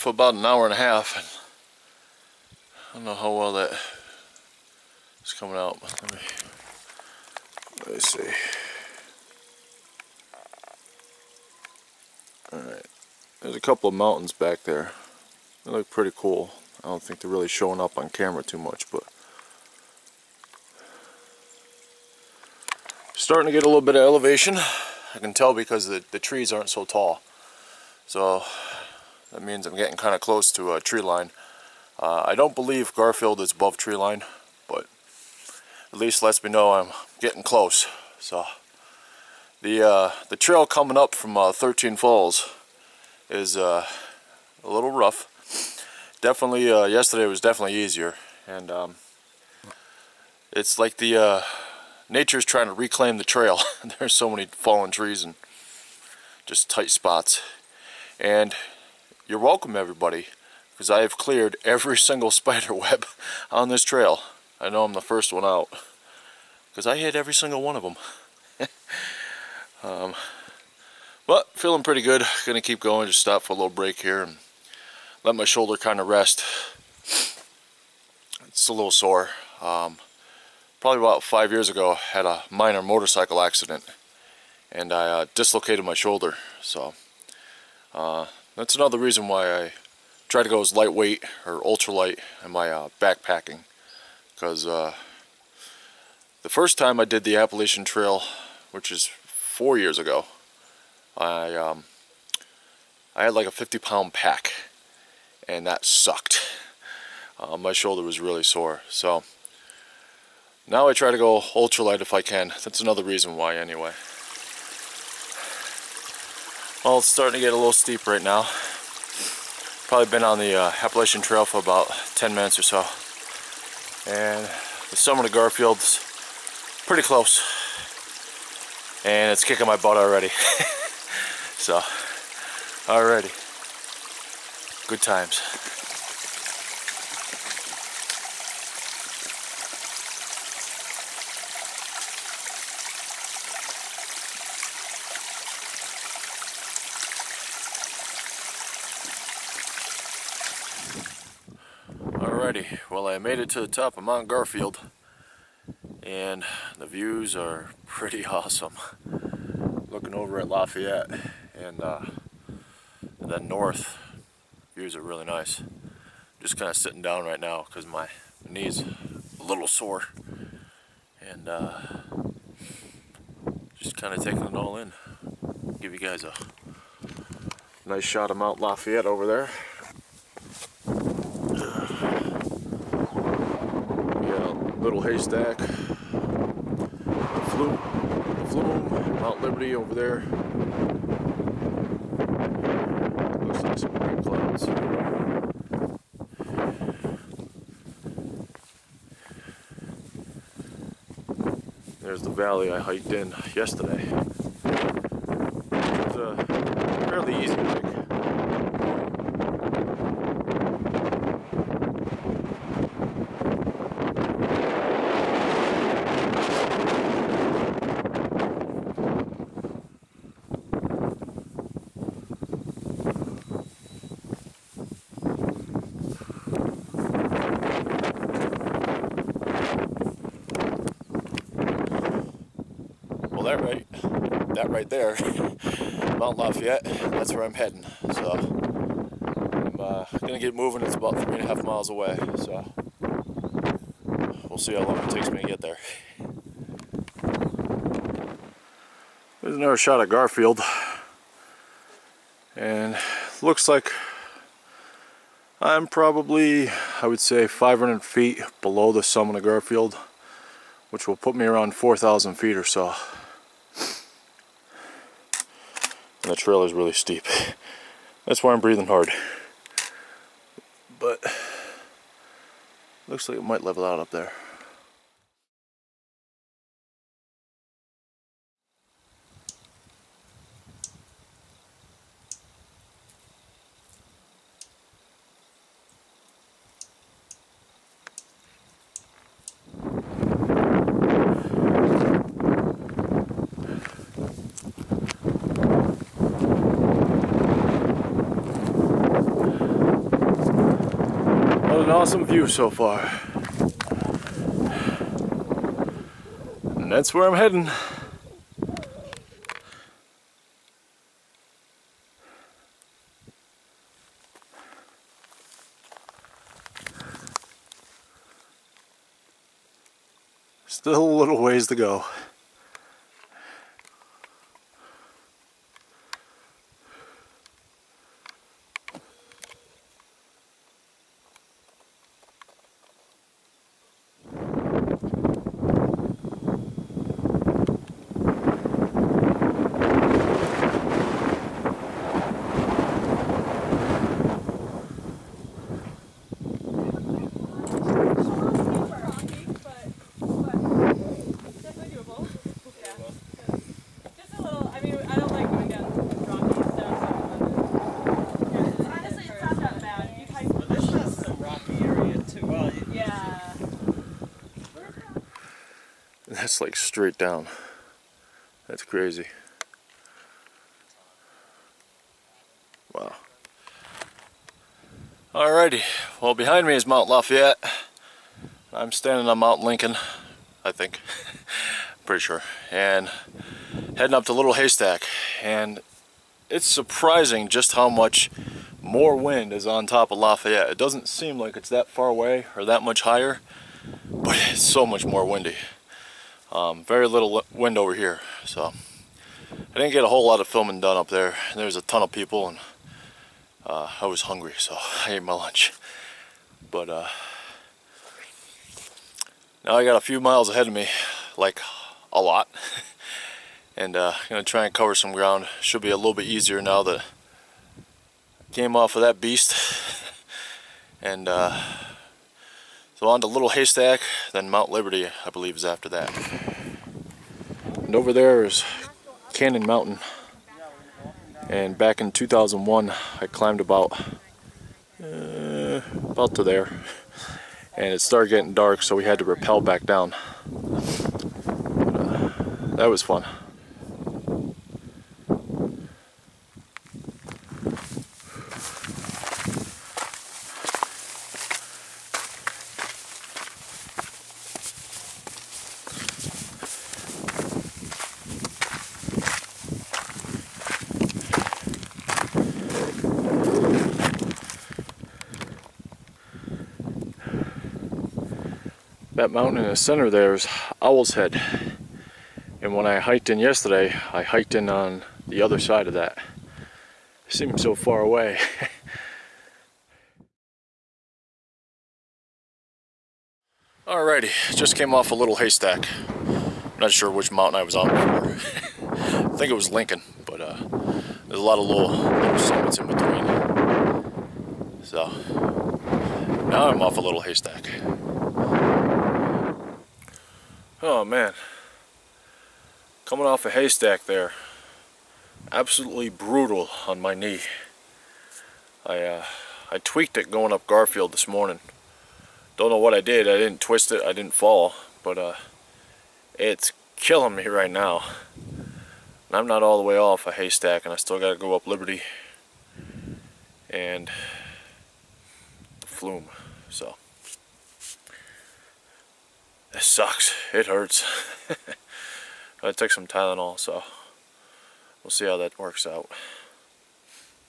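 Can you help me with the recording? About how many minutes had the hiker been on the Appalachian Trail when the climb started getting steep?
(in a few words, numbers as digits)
10 minutes.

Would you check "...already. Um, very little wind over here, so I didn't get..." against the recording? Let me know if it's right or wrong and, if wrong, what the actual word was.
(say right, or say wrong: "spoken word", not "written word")
wrong: "windy", not "already".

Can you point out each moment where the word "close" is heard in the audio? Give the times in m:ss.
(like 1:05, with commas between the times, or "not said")
0:30, 0:37, 2:07.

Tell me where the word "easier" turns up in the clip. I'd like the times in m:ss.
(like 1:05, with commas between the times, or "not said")
0:47, 6:56.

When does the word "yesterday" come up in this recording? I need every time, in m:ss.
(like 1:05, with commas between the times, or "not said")
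0:46, 3:23, 7:53.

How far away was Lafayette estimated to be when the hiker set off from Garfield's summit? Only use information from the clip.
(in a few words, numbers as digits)
3.5 miles.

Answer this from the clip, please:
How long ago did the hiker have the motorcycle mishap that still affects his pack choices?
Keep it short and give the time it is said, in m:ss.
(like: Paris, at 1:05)
5 years, at 1:21.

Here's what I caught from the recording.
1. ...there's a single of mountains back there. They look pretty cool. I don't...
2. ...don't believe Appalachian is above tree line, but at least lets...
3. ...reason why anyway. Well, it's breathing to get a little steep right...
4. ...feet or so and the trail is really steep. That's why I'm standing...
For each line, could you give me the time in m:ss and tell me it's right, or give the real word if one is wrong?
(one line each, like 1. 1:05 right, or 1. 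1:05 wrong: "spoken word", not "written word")
1. 0:13 wrong: "couple", not "single"
2. 0:32 wrong: "Garfield", not "Appalachian"
3. 1:53 wrong: "starting", not "breathing"
4. 4:22 wrong: "breathing", not "standing".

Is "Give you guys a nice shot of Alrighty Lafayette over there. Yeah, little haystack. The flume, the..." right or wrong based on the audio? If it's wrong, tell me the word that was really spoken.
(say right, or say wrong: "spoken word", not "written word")
wrong: "Mount", not "Alrighty".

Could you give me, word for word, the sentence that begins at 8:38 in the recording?
And I'm not all the way off a haystack and I still gotta go up Liberty and the flume, so.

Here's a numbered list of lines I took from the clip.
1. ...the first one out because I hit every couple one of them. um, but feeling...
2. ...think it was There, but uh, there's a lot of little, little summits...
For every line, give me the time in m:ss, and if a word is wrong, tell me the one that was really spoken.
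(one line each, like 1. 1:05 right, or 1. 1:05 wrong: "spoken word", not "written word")
1. 1:04 wrong: "single", not "couple"
2. 8:09 wrong: "Lincoln", not "There".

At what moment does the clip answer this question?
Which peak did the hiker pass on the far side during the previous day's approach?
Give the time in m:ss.
7:50.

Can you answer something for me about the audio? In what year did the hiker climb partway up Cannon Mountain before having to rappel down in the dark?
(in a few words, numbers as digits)
2001.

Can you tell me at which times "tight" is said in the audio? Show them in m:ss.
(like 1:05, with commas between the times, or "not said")
0:56.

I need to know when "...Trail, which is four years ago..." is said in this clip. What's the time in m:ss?
1:37.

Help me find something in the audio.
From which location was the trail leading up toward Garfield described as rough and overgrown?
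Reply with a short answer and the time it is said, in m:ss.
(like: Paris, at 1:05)
13 Falls, at 0:41.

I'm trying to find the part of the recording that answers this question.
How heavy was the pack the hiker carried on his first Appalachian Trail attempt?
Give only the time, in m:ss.
1:43.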